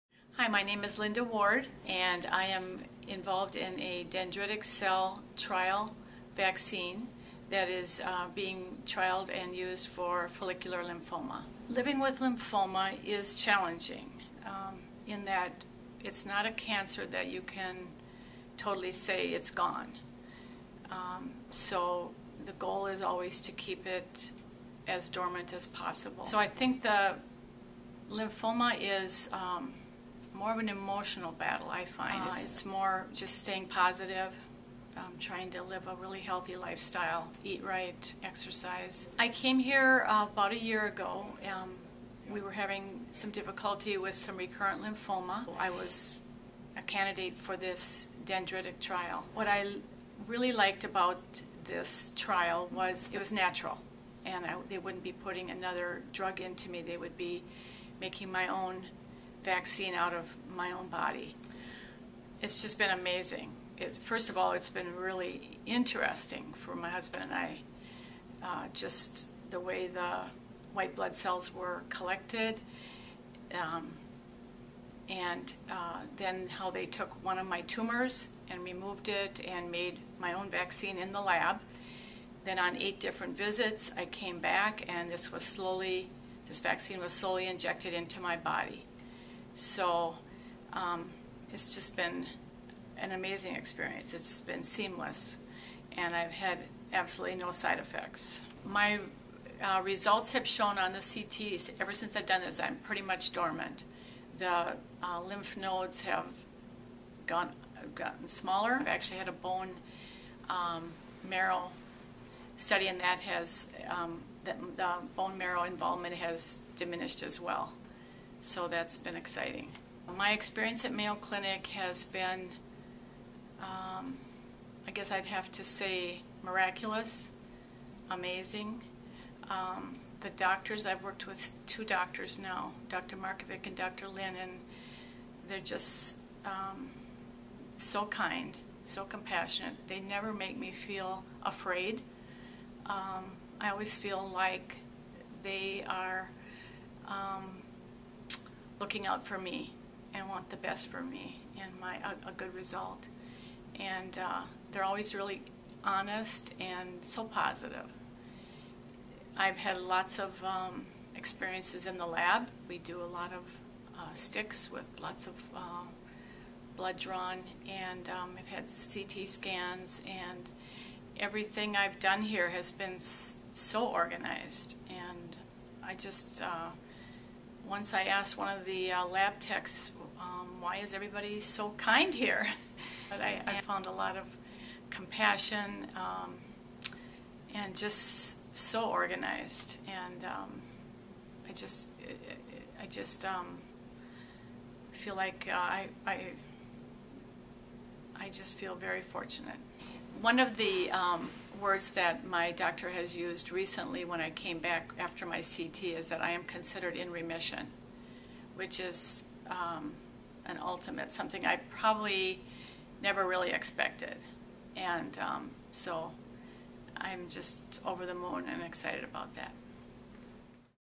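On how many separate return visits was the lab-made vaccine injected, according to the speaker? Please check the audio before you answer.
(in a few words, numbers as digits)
8.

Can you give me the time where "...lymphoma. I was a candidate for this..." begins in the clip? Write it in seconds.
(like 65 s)
44 s.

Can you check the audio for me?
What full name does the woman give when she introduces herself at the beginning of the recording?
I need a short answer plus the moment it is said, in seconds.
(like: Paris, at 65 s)
Linda Ward, at 0 s.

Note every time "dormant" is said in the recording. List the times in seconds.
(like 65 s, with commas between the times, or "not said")
25 s, 103 s.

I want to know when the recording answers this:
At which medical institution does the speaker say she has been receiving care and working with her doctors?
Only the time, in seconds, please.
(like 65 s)
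120 s.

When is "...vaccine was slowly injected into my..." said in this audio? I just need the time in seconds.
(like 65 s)
86 s.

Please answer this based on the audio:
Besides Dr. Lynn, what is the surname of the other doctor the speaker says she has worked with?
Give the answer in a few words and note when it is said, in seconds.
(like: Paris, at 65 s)
Markovic, at 133 s.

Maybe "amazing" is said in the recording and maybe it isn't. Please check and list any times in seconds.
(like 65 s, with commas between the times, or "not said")
62 s, 93 s, 128 s.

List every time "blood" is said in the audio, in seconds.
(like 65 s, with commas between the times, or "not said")
70 s, 166 s.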